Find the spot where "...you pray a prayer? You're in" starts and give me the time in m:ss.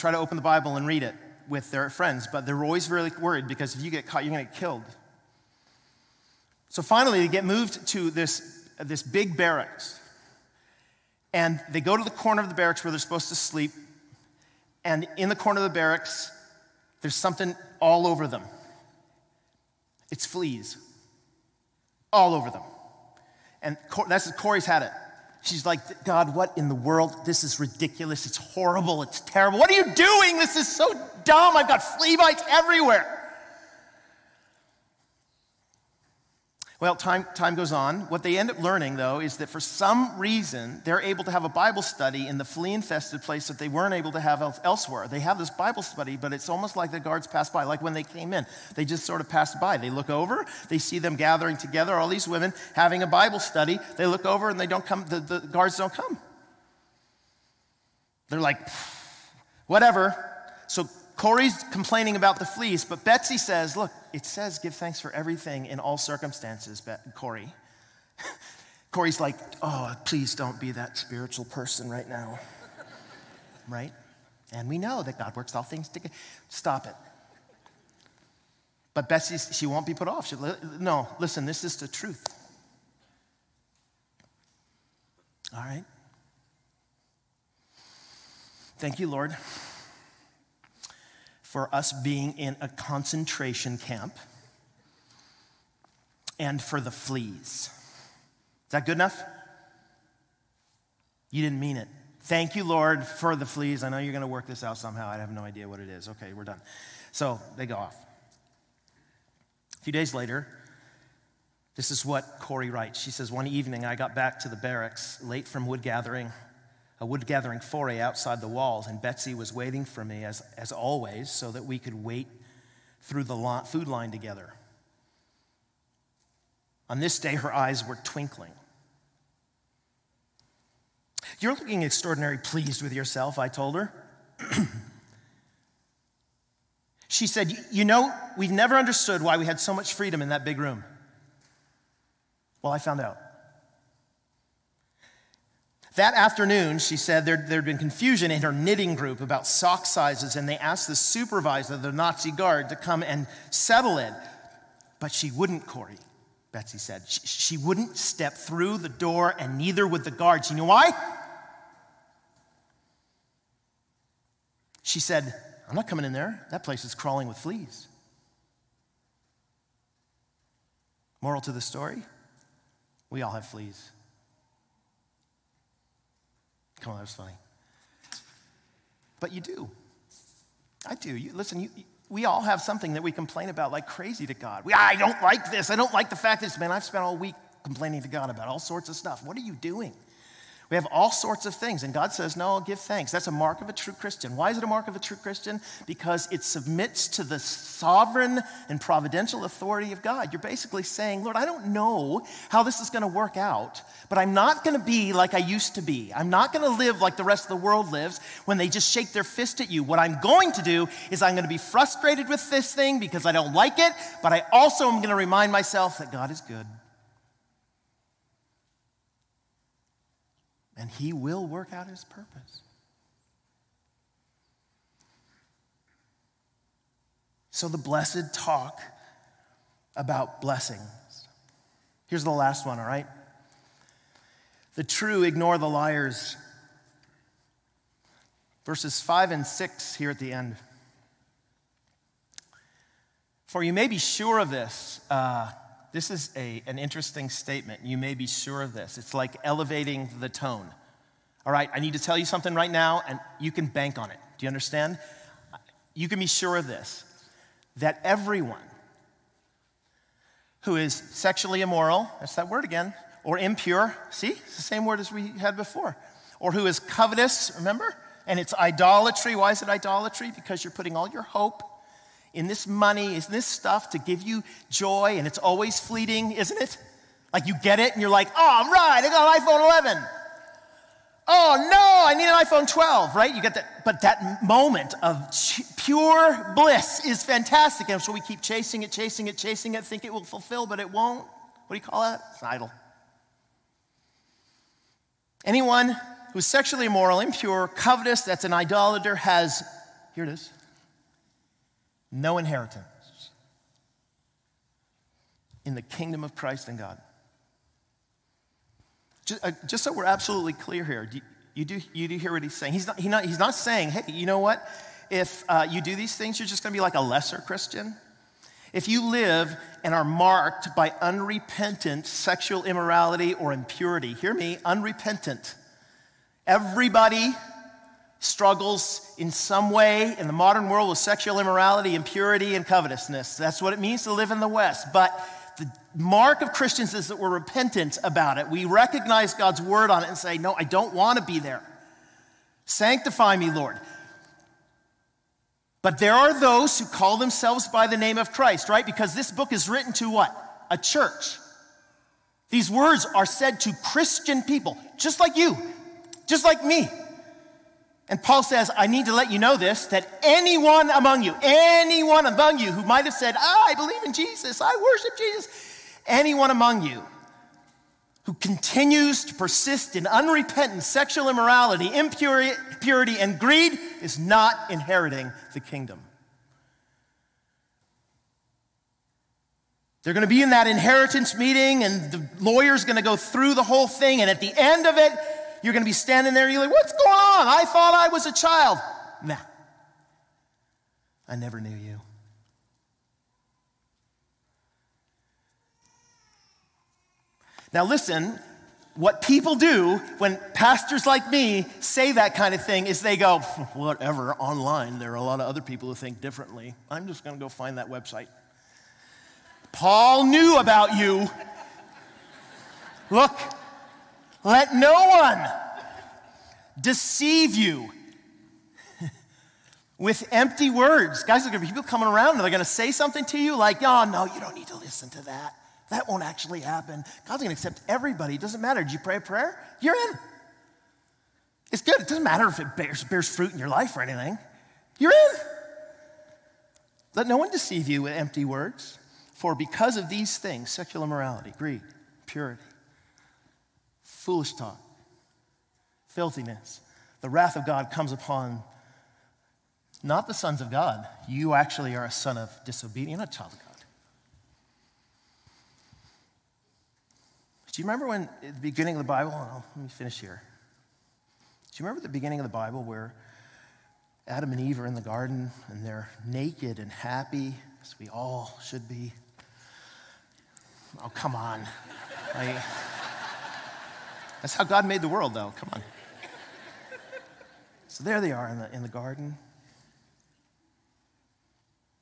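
7:08.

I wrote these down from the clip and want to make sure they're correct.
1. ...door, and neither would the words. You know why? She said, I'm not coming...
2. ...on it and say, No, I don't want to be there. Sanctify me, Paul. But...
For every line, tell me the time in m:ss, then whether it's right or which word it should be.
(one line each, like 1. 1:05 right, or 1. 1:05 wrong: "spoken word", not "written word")
1. 2:38 wrong: "guards", not "words"
2. 5:39 wrong: "Lord", not "Paul".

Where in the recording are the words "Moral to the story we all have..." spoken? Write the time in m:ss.
2:51.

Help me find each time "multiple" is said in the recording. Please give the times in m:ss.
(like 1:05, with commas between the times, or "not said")
not said.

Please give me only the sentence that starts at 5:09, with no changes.
Uh, just, so we're absolutely clear here, you, do, you do hear what he's saying.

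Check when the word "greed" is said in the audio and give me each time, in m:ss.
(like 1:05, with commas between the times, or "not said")
6:13, 7:21.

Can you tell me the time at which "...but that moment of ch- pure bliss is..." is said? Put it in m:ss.
4:43.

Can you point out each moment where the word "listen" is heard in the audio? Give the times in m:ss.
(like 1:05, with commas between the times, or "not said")
1:21, 3:01, 6:37, 7:04.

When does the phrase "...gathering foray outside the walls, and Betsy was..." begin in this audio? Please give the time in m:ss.
1:57.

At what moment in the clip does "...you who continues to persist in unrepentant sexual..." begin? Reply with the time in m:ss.
6:06.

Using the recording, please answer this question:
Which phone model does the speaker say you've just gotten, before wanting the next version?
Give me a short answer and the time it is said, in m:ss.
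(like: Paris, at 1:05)
iPhone 11, at 4:39.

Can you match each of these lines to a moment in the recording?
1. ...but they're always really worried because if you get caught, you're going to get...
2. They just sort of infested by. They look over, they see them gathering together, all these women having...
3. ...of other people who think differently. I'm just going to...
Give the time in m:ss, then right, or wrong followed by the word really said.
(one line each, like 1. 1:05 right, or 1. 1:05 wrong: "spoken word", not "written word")
1. 0:02 right
2. 0:48 wrong: "passed", not "infested"
3. 6:45 right.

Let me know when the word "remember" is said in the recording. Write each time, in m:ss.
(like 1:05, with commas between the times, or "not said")
4:27, 7:37, 7:41.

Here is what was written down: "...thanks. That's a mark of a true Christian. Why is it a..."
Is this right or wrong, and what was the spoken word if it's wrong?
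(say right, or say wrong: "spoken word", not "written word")
right.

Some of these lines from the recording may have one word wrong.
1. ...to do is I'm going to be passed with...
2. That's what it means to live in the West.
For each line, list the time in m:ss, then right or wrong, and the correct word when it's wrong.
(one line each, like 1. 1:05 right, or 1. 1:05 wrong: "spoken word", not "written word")
1. 3:30 wrong: "frustrated", not "passed"
2. 5:33 right.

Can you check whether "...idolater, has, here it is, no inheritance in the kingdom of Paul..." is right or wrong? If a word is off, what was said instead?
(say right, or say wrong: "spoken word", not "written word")
wrong: "Christ", not "Paul".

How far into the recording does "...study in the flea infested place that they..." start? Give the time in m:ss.
0:41.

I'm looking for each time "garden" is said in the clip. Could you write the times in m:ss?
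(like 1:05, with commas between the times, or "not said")
7:45, 7:58.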